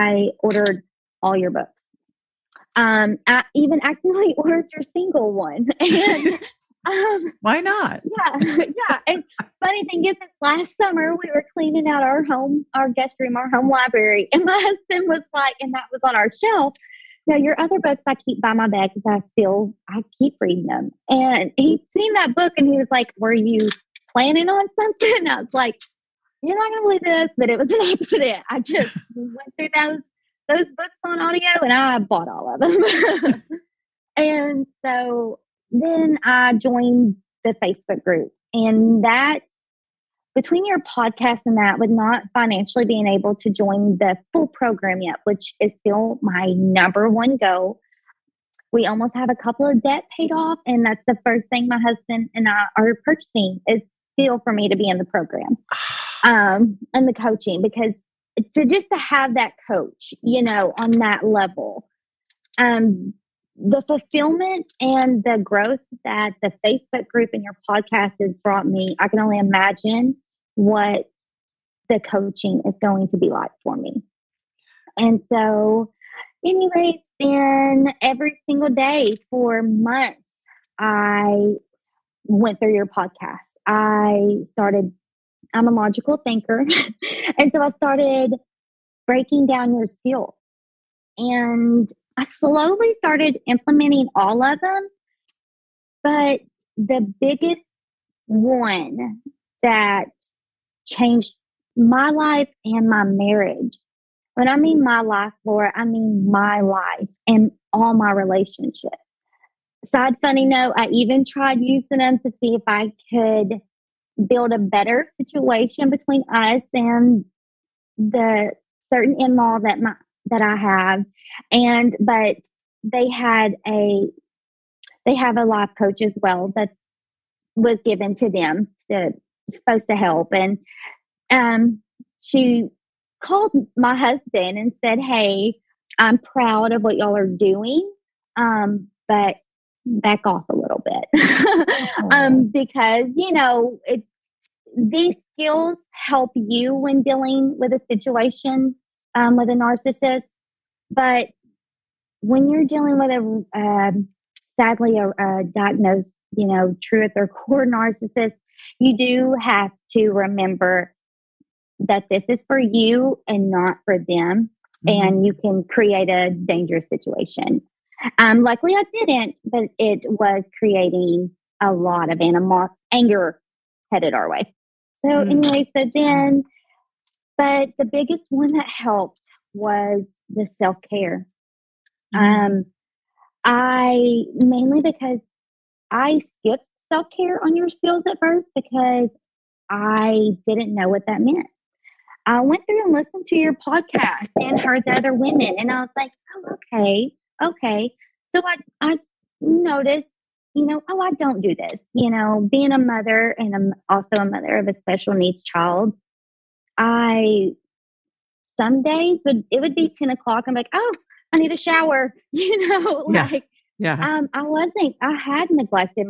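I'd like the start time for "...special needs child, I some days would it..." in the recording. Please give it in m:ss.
3:24.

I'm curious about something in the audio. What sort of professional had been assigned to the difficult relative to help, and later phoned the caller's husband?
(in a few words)
life coach.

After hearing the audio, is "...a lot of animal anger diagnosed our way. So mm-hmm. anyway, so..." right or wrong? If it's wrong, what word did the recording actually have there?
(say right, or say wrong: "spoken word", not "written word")
wrong: "headed", not "diagnosed".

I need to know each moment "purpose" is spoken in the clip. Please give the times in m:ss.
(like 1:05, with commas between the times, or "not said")
not said.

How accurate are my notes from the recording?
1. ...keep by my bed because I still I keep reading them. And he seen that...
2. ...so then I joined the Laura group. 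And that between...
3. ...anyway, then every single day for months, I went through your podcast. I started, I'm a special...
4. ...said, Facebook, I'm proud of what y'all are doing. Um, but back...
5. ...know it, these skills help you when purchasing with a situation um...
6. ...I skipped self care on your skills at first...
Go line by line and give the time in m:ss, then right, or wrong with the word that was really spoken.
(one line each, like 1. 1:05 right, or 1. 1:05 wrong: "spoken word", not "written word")
1. 0:18 right
2. 0:34 wrong: "Facebook", not "Laura"
3. 1:16 wrong: "logical", not "special"
4. 2:14 wrong: "Hey", not "Facebook"
5. 2:23 wrong: "dealing", not "purchasing"
6. 3:05 right.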